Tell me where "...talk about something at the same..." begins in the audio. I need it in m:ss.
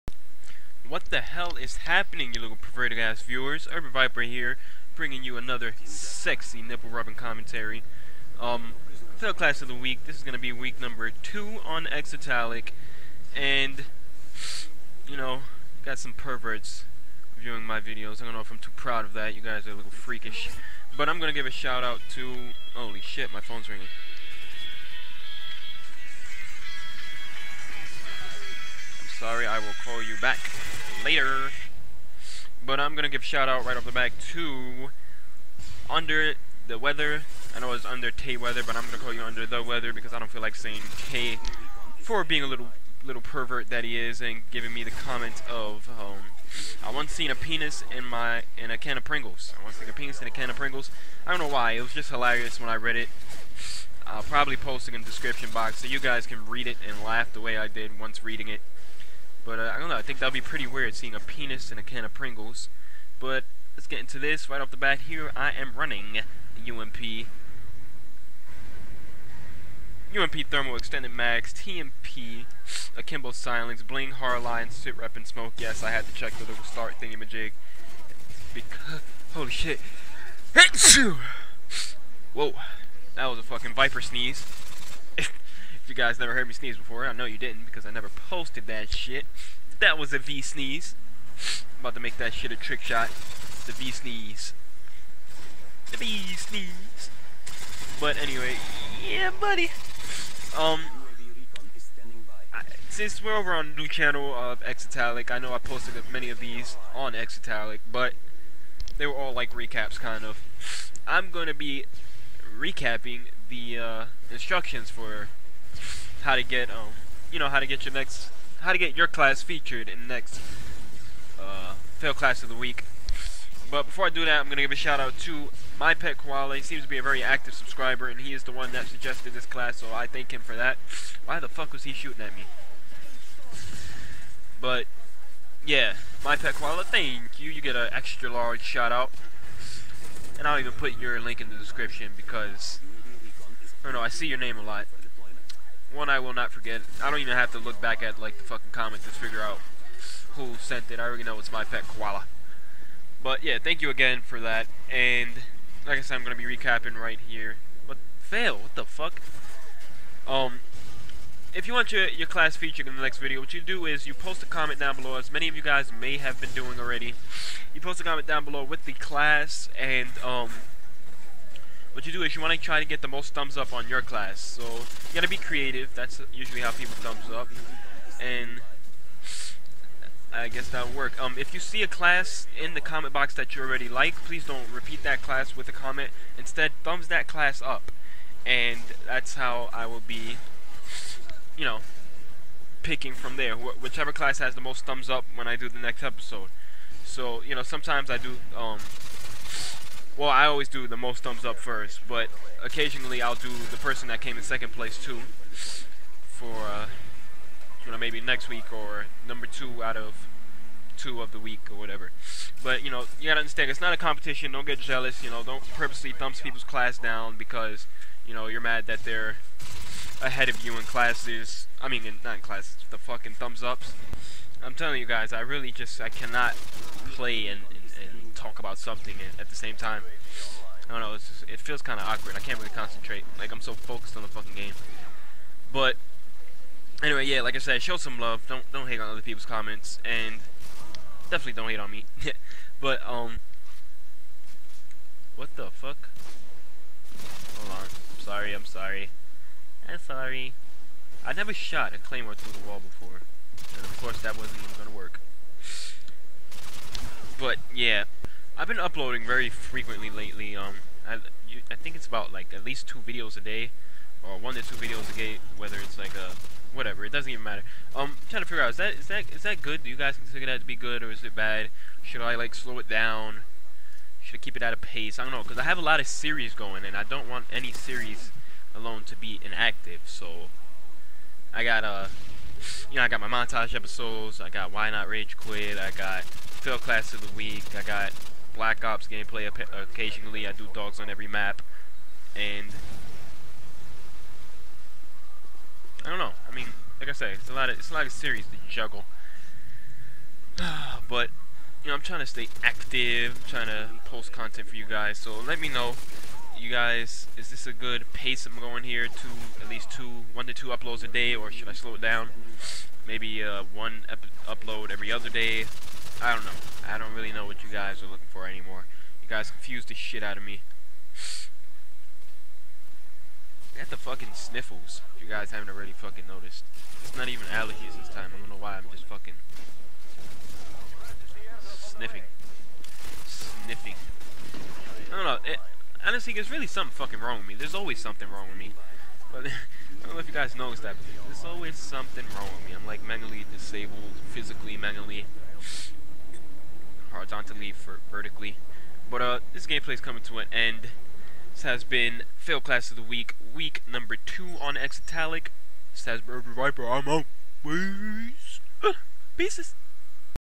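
3:48.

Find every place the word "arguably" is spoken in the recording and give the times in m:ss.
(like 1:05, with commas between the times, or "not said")
not said.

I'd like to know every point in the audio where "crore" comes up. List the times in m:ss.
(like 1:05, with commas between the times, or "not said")
not said.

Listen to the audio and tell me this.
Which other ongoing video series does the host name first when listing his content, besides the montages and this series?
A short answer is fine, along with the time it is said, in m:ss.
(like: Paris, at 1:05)
Why Not Rage Quit, at 4:44.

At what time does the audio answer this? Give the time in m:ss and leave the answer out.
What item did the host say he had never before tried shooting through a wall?
4:11.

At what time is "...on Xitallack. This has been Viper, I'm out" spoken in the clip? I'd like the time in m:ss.
5:54.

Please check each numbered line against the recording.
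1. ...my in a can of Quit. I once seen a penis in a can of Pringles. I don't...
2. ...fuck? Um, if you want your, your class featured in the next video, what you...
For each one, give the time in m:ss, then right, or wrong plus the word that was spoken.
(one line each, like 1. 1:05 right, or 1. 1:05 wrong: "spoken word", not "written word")
1. 0:48 wrong: "Pringles", not "Quit"
2. 2:38 right.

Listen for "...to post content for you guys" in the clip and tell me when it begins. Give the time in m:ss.
5:03.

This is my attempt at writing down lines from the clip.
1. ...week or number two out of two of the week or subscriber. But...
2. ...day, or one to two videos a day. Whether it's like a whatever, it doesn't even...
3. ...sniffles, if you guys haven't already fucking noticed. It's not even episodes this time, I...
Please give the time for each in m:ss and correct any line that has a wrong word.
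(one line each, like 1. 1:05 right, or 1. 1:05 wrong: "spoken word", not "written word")
1. 3:28 wrong: "whatever", not "subscriber"
2. 4:23 right
3. 5:24 wrong: "allergies", not "episodes".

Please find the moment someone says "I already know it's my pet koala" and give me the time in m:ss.
2:30.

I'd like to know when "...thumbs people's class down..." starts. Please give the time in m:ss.
3:36.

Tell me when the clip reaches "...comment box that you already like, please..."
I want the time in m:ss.
3:02.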